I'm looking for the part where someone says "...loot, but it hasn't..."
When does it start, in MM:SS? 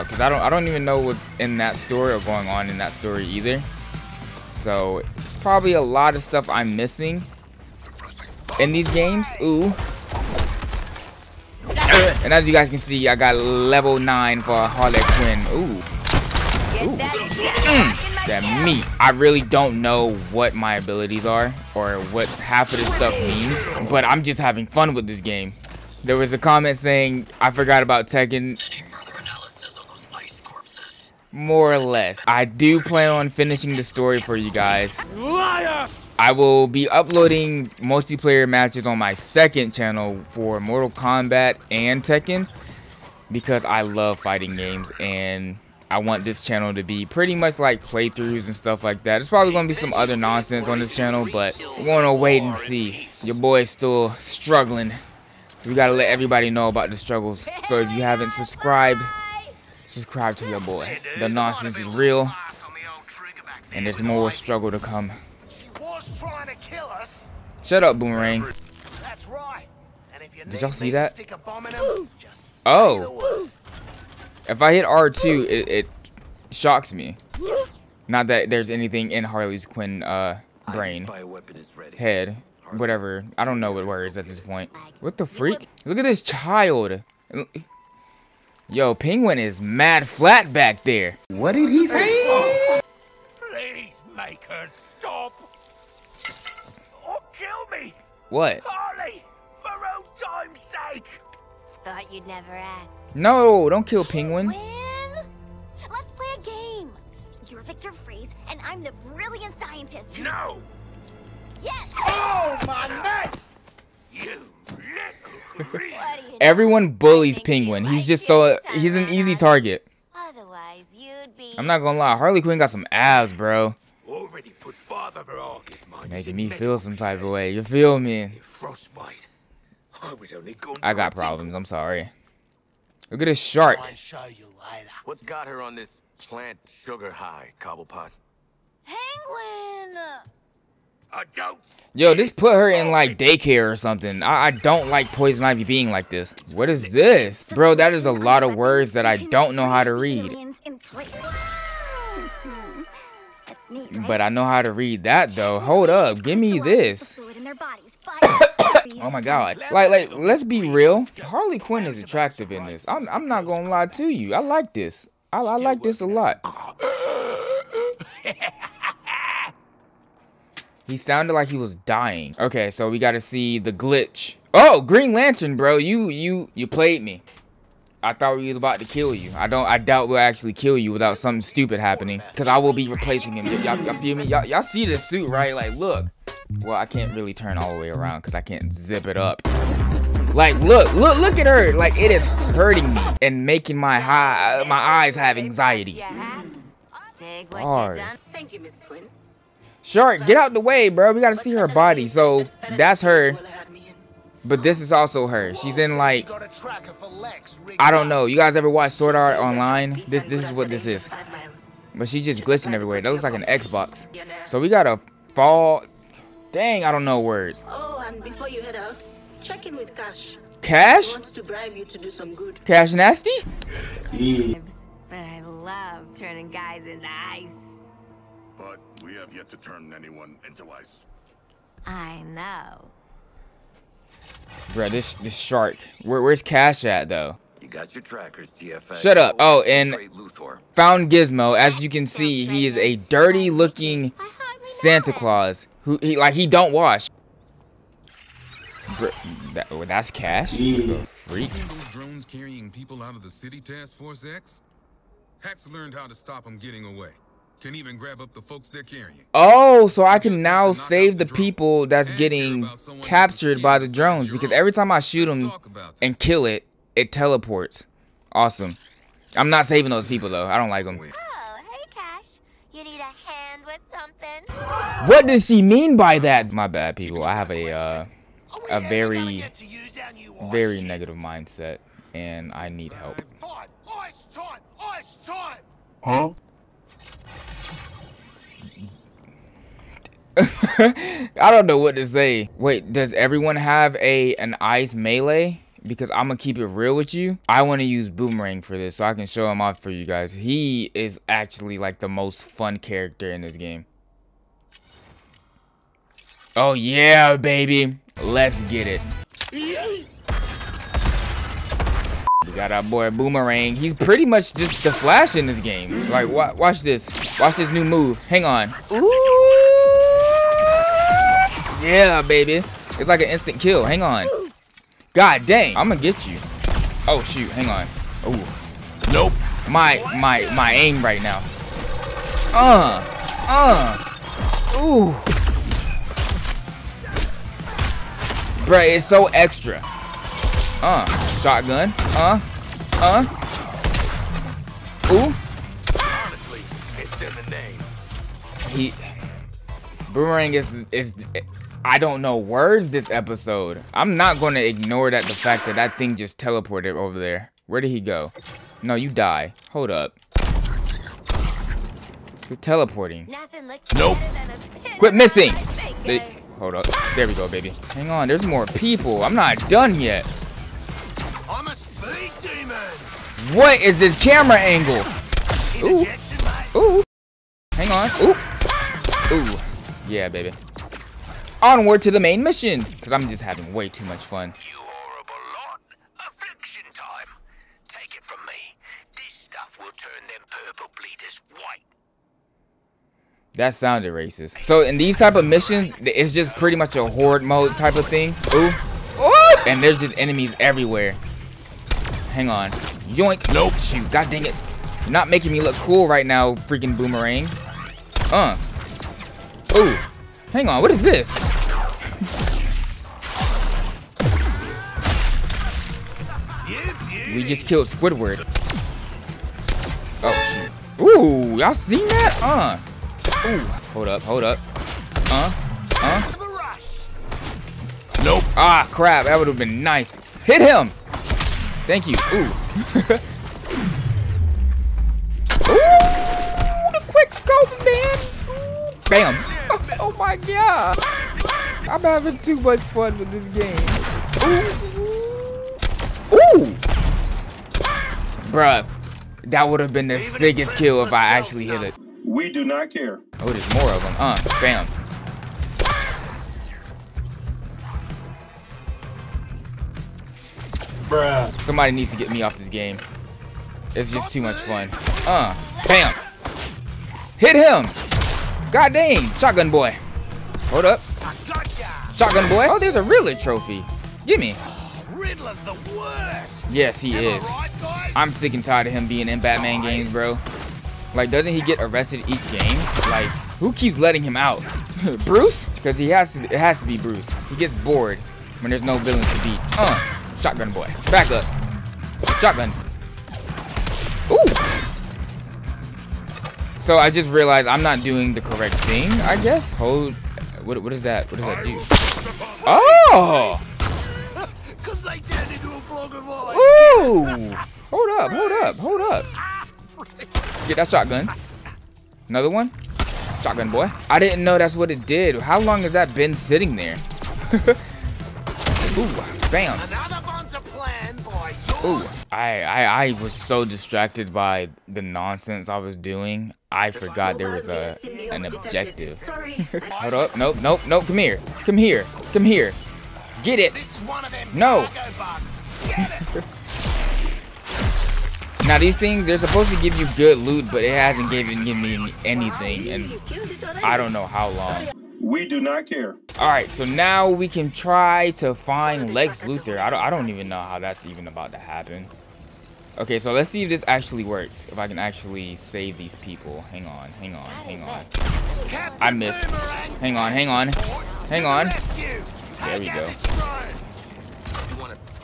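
09:00.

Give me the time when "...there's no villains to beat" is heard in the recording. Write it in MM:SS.
08:08.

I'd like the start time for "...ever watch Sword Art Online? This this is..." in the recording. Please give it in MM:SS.
03:28.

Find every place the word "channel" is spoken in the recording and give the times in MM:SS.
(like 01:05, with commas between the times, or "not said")
00:39, 00:46, 00:50.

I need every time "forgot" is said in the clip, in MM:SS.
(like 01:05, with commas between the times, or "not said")
00:27, 08:46.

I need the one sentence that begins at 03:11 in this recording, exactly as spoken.
Like, it is hurting me and making my high, uh, my eyes have anxiety.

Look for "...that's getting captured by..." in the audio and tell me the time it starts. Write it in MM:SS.
04:21.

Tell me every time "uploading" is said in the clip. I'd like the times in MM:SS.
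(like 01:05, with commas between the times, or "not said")
00:36.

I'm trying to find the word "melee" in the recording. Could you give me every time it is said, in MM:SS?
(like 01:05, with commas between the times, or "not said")
04:54.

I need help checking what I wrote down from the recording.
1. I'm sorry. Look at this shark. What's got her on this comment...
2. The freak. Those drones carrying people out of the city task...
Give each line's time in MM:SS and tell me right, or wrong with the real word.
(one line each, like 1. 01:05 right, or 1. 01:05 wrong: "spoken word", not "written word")
1. 02:11 wrong: "plant", not "comment"
2. 04:10 right.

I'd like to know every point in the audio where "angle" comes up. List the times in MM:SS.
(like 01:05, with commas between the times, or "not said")
06:14.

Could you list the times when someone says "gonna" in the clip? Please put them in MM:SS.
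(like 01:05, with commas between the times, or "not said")
02:01, 02:43, 04:56, 05:25.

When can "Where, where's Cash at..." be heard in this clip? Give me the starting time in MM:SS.
03:56.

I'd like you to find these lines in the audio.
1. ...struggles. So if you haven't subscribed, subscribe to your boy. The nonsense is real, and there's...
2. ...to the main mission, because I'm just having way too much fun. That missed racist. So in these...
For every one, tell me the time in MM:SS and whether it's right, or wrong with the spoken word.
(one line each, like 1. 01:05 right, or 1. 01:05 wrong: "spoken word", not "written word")
1. 00:56 right
2. 06:22 wrong: "sounded", not "missed".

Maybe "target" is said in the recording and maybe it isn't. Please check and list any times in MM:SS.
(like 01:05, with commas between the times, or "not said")
01:59.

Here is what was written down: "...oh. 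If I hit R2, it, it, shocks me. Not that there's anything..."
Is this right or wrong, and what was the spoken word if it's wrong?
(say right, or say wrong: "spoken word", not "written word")
right.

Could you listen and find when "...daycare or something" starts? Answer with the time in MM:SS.
02:23.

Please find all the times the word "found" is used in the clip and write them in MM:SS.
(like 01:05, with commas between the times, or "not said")
04:00.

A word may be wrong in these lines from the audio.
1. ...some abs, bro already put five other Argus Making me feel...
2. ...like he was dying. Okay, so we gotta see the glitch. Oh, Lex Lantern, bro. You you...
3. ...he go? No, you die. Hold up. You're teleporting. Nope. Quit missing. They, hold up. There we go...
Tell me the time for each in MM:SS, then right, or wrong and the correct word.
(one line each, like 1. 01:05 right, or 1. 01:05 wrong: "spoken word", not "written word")
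1. 02:02 right
2. 02:51 wrong: "Green", not "Lex"
3. 05:57 right.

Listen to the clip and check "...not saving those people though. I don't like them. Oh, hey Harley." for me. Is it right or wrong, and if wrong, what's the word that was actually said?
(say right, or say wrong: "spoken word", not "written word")
wrong: "Cash", not "Harley".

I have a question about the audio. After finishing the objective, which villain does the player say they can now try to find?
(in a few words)
Lex Luthor.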